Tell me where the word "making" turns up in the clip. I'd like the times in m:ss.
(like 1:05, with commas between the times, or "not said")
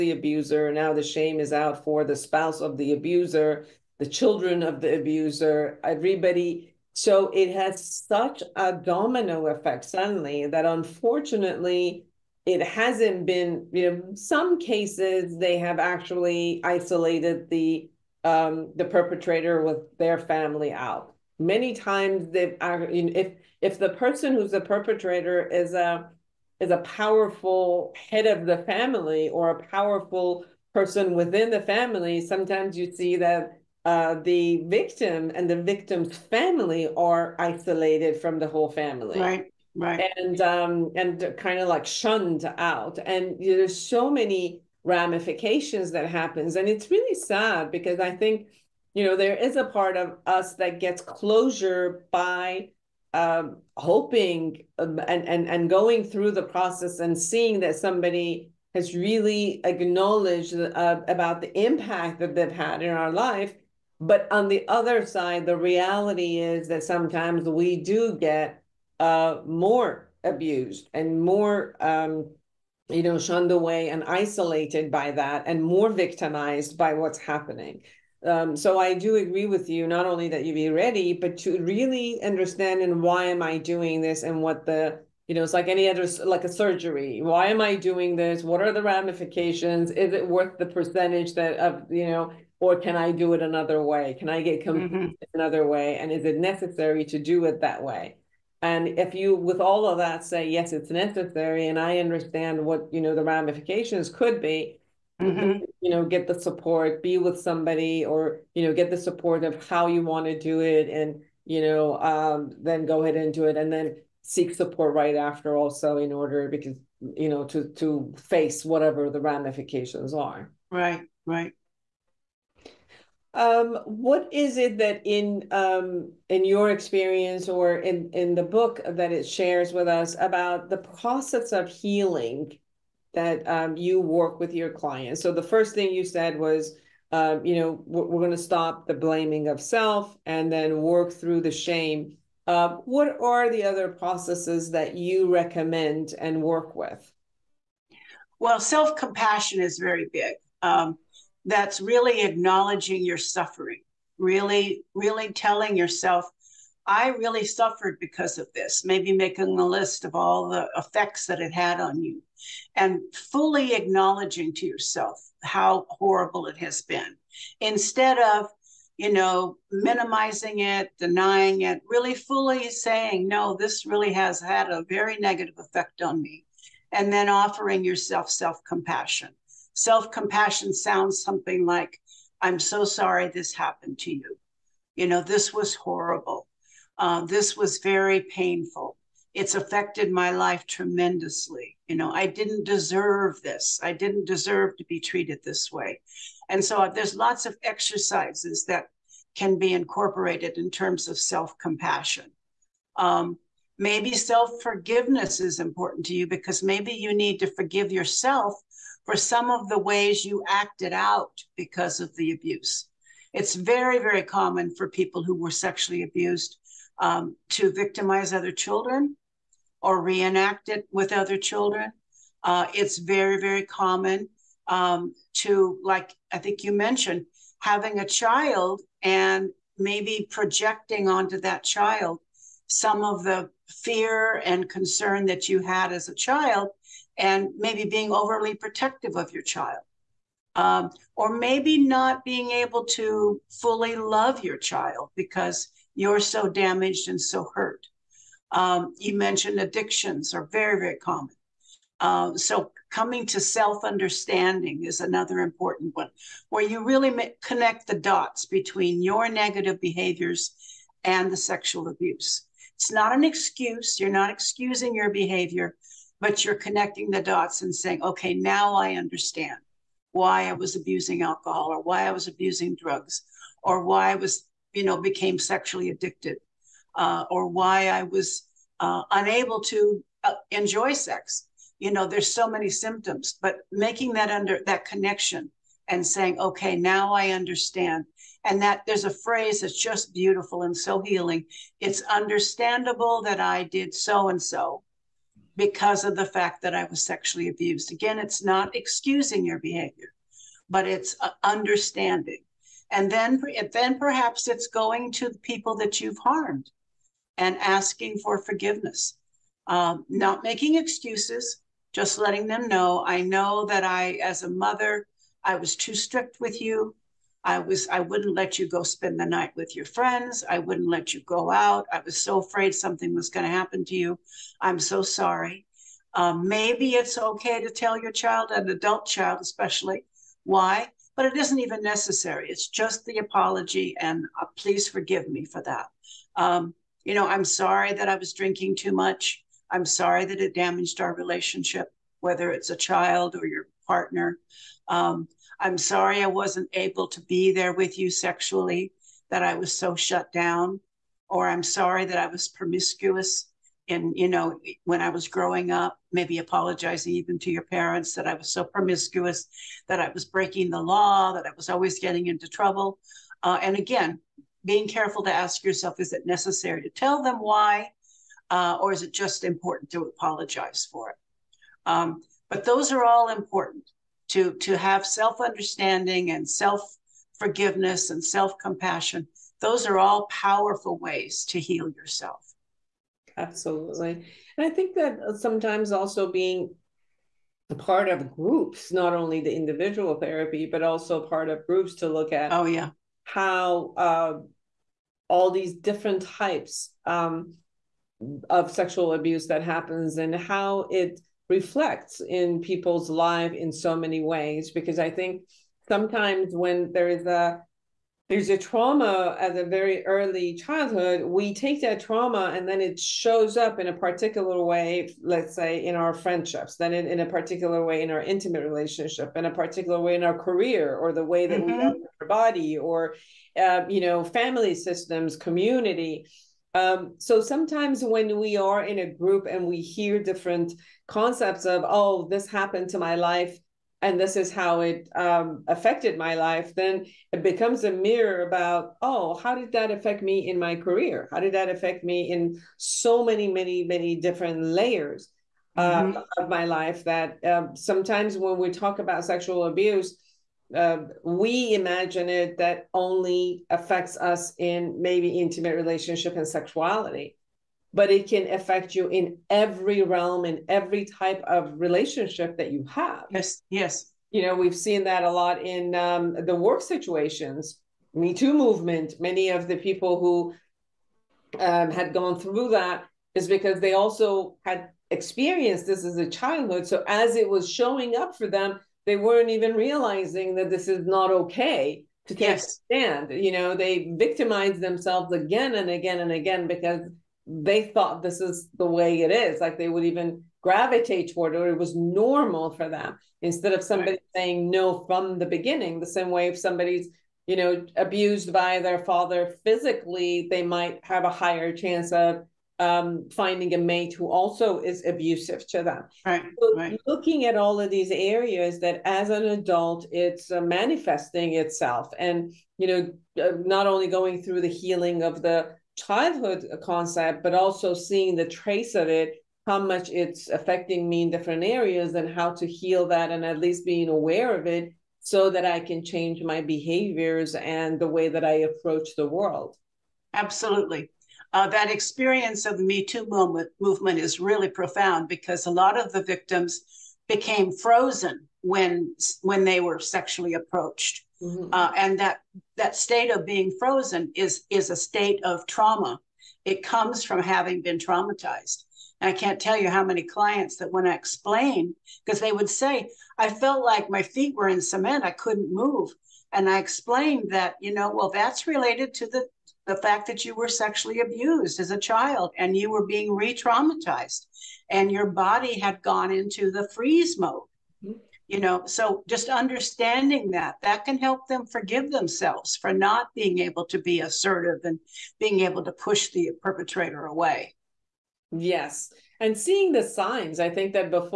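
2:39, 4:43, 5:10.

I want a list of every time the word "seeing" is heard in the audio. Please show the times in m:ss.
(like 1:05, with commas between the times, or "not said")
0:57, 8:37, 9:39.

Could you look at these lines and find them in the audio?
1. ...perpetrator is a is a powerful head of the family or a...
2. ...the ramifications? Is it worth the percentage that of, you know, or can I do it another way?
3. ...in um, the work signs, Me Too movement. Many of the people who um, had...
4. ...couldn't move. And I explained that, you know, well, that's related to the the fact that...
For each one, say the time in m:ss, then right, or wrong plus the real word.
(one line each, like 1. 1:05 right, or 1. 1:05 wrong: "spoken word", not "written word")
1. 0:24 right
2. 1:28 right
3. 7:45 wrong: "situations", not "signs"
4. 9:15 right.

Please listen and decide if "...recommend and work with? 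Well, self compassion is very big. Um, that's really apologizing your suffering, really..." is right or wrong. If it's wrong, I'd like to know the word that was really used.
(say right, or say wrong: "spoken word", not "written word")
wrong: "acknowledging", not "apologizing".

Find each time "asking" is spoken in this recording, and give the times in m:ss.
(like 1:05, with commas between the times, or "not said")
5:07.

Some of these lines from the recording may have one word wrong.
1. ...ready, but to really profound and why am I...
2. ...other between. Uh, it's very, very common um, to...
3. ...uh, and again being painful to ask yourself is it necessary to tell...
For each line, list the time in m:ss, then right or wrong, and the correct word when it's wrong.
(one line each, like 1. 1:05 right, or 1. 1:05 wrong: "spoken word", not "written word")
1. 1:20 wrong: "understand", not "profound"
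2. 3:41 wrong: "children", not "between"
3. 6:03 wrong: "careful", not "painful".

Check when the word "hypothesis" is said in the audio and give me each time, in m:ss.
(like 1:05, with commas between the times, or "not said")
not said.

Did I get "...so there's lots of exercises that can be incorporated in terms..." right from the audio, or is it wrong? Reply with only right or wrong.
right.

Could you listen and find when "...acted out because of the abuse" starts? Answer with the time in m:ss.
3:30.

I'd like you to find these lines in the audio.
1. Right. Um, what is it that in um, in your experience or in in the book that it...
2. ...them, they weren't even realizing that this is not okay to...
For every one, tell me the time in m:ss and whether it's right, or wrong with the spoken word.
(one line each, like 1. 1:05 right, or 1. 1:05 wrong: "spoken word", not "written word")
1. 2:01 right
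2. 7:58 right.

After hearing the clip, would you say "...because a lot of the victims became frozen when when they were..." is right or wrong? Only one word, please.
right.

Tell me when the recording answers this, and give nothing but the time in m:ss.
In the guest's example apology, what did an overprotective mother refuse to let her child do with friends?
5:18.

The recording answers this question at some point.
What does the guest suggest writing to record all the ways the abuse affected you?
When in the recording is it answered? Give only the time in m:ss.
2:39.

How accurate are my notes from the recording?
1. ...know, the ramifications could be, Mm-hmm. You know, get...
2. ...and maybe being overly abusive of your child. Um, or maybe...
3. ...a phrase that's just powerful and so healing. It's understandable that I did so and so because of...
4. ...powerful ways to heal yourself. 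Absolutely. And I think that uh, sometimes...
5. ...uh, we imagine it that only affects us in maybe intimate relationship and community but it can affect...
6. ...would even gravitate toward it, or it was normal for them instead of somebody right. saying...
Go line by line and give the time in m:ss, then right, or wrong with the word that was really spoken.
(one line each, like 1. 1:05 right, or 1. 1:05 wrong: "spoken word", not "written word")
1. 1:43 right
2. 3:57 wrong: "protective", not "abusive"
3. 4:49 wrong: "beautiful", not "powerful"
4. 6:20 right
5. 7:30 wrong: "sexuality", not "community"
6. 8:09 right.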